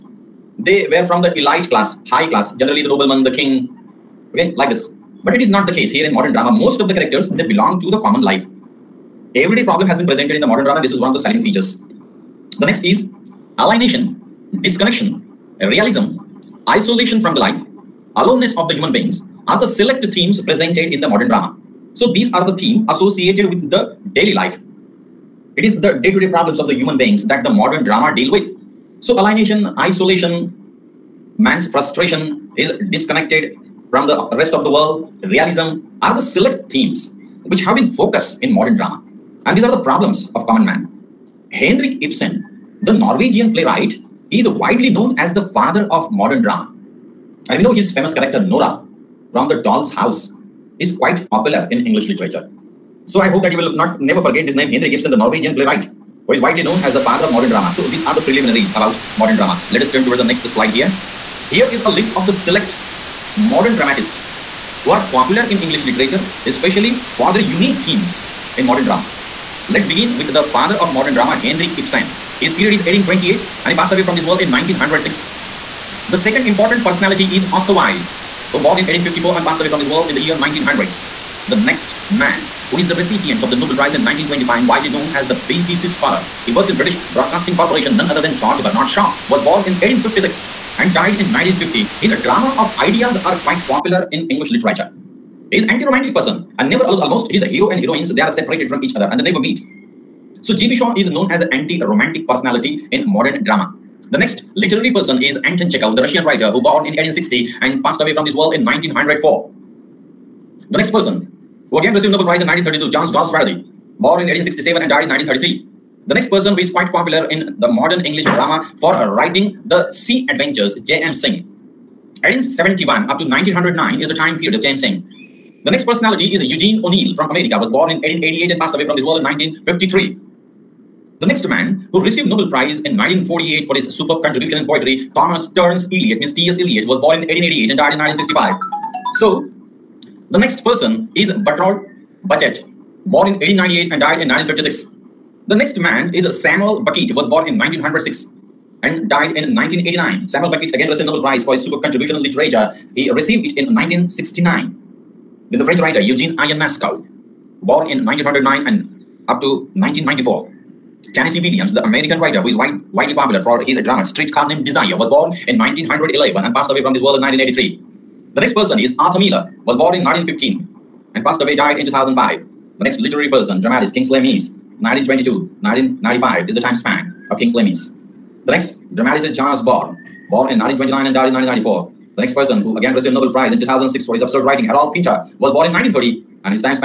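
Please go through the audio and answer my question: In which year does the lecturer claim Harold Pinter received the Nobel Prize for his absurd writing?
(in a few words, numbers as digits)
2006.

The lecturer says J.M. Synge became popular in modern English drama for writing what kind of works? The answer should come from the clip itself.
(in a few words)
Sea Adventures.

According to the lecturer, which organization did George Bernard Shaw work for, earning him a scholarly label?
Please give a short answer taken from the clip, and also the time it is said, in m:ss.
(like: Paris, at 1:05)
British Broadcasting Corporation, at 1:26.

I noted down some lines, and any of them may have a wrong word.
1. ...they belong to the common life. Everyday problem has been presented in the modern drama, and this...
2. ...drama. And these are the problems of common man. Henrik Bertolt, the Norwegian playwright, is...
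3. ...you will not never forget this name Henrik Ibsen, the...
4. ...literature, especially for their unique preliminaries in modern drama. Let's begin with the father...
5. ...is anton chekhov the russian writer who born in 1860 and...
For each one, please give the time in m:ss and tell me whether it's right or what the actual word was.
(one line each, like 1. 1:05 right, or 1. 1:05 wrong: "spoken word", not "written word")
1. 0:07 right
2. 0:38 wrong: "Ibsen", not "Bertolt"
3. 0:53 right
4. 1:05 wrong: "themes", not "preliminaries"
5. 1:45 right.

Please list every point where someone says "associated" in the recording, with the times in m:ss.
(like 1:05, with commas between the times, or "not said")
0:22.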